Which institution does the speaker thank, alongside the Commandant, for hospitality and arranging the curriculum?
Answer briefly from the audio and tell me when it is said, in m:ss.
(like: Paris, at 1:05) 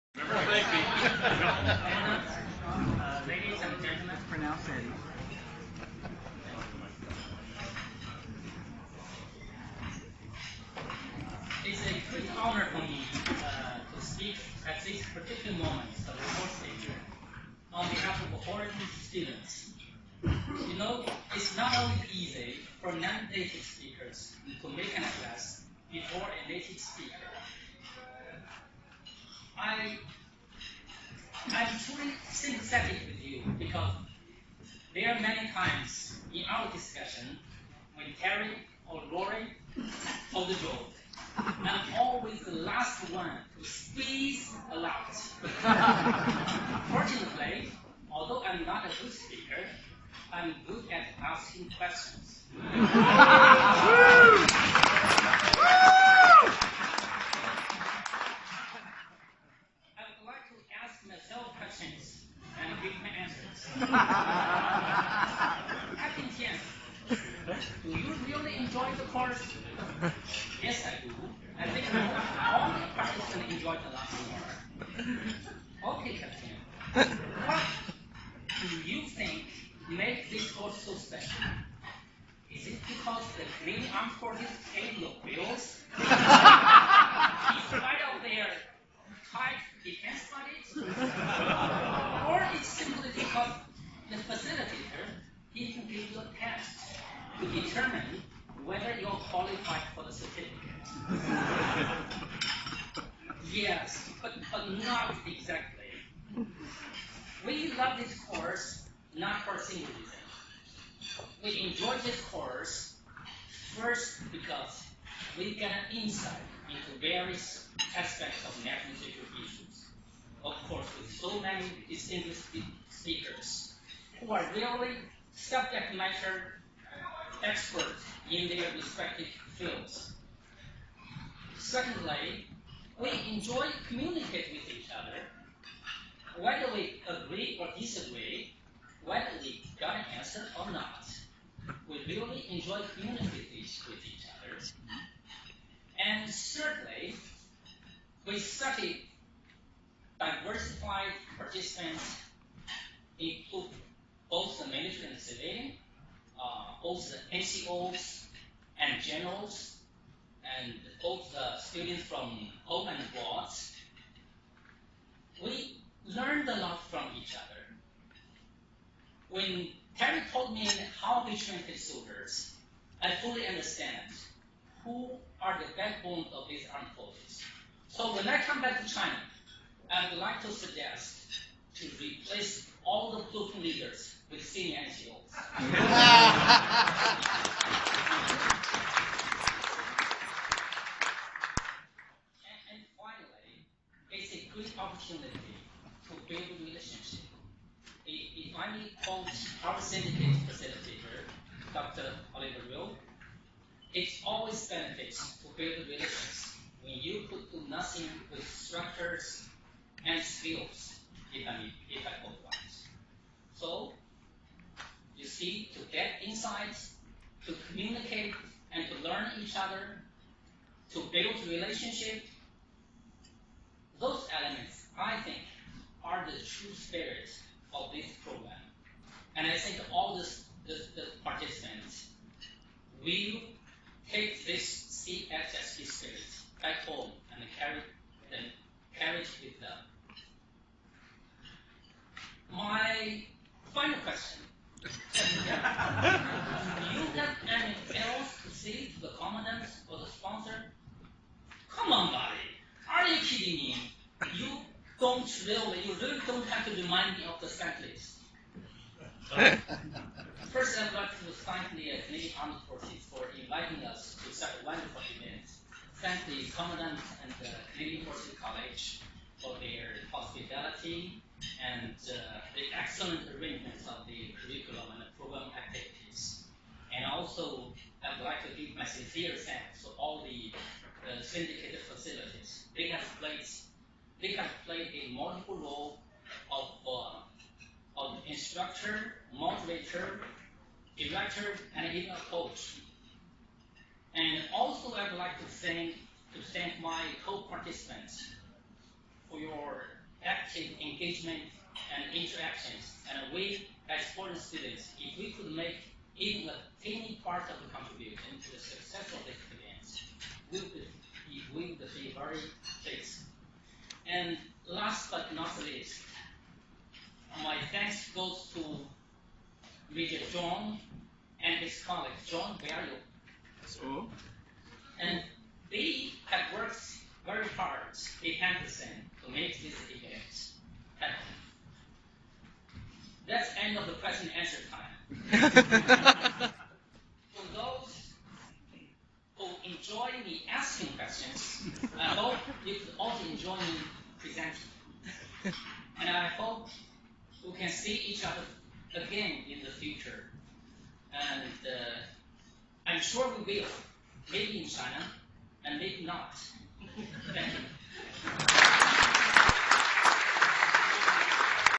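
Canadian Forces College, at 4:27.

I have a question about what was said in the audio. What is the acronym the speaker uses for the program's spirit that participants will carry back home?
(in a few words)
CSSP.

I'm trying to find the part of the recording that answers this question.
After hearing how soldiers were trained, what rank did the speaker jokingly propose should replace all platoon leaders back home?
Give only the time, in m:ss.
3:04.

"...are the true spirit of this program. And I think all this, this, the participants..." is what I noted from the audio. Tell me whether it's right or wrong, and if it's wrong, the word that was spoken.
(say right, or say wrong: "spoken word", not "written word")
right.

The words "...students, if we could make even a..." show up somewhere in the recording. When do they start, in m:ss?
5:04.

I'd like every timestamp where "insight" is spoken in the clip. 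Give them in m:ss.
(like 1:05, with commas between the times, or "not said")
1:55, 3:36.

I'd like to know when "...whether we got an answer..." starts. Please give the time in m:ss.
2:19.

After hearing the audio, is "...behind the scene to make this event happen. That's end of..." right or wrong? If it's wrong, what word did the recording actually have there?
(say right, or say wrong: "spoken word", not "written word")
right.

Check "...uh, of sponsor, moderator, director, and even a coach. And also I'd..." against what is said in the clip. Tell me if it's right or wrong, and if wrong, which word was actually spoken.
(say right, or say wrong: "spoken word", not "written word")
wrong: "instructor", not "sponsor".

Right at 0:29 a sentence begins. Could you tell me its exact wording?
I I'm truly sympathetic with you because there are many times in our discussion when Terry or Lori told the joke.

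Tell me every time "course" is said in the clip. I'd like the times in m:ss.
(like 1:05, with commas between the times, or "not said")
0:16, 1:09, 1:20, 1:48, 1:52, 2:00.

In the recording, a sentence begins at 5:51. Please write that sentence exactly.
And uh, I'm sure we will, maybe in China, and maybe not.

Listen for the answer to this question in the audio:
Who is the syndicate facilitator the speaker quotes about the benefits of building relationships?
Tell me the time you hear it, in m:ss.
3:21.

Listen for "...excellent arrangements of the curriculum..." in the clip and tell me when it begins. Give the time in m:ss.
4:32.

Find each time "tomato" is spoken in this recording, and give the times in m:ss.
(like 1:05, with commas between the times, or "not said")
not said.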